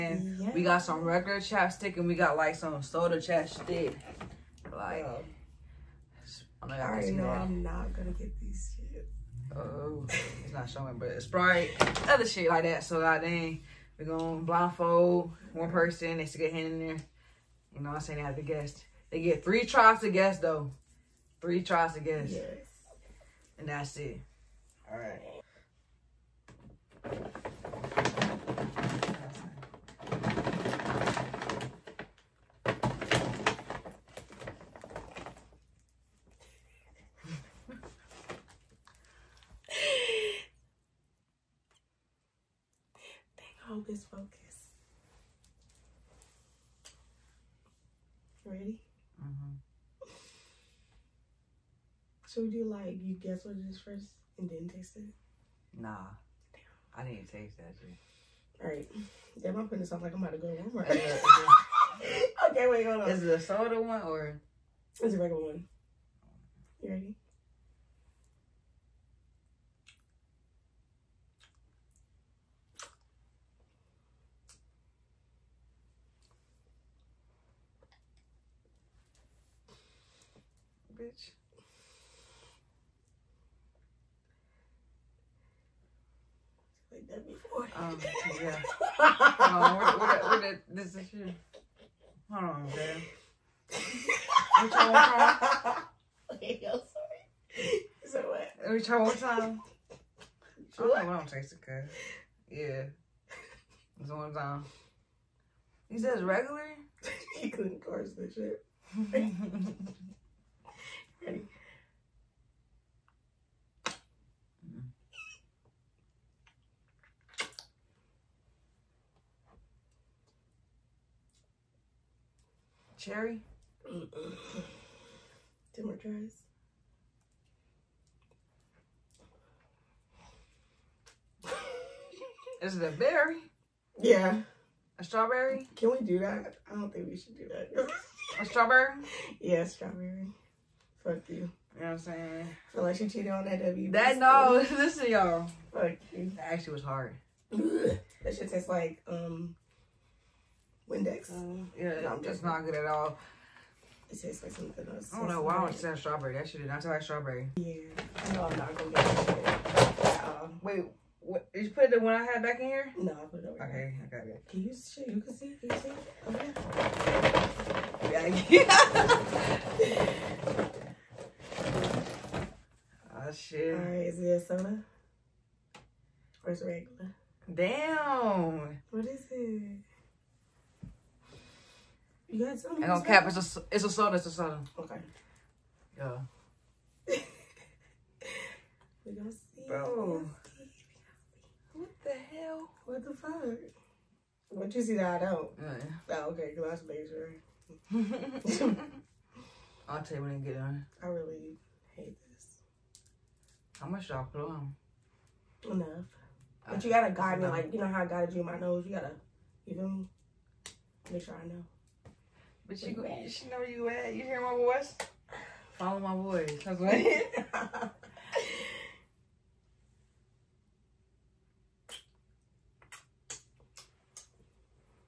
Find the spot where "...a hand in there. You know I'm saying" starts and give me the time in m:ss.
0:16.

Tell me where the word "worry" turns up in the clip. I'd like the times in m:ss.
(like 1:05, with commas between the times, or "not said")
not said.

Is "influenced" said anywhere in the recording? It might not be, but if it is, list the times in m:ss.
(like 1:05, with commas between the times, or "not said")
not said.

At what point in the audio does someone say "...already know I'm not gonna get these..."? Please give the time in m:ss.
0:06.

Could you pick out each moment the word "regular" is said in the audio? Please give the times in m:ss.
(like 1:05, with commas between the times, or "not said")
0:01, 1:05, 1:46, 2:56.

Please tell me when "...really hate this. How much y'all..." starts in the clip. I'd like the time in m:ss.
3:21.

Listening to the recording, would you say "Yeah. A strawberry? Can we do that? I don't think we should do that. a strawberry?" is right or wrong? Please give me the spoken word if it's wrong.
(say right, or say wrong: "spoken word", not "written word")
right.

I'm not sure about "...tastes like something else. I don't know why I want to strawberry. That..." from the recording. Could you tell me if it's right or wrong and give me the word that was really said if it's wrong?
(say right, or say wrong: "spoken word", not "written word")
right.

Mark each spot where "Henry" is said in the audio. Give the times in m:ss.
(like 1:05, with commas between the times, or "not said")
not said.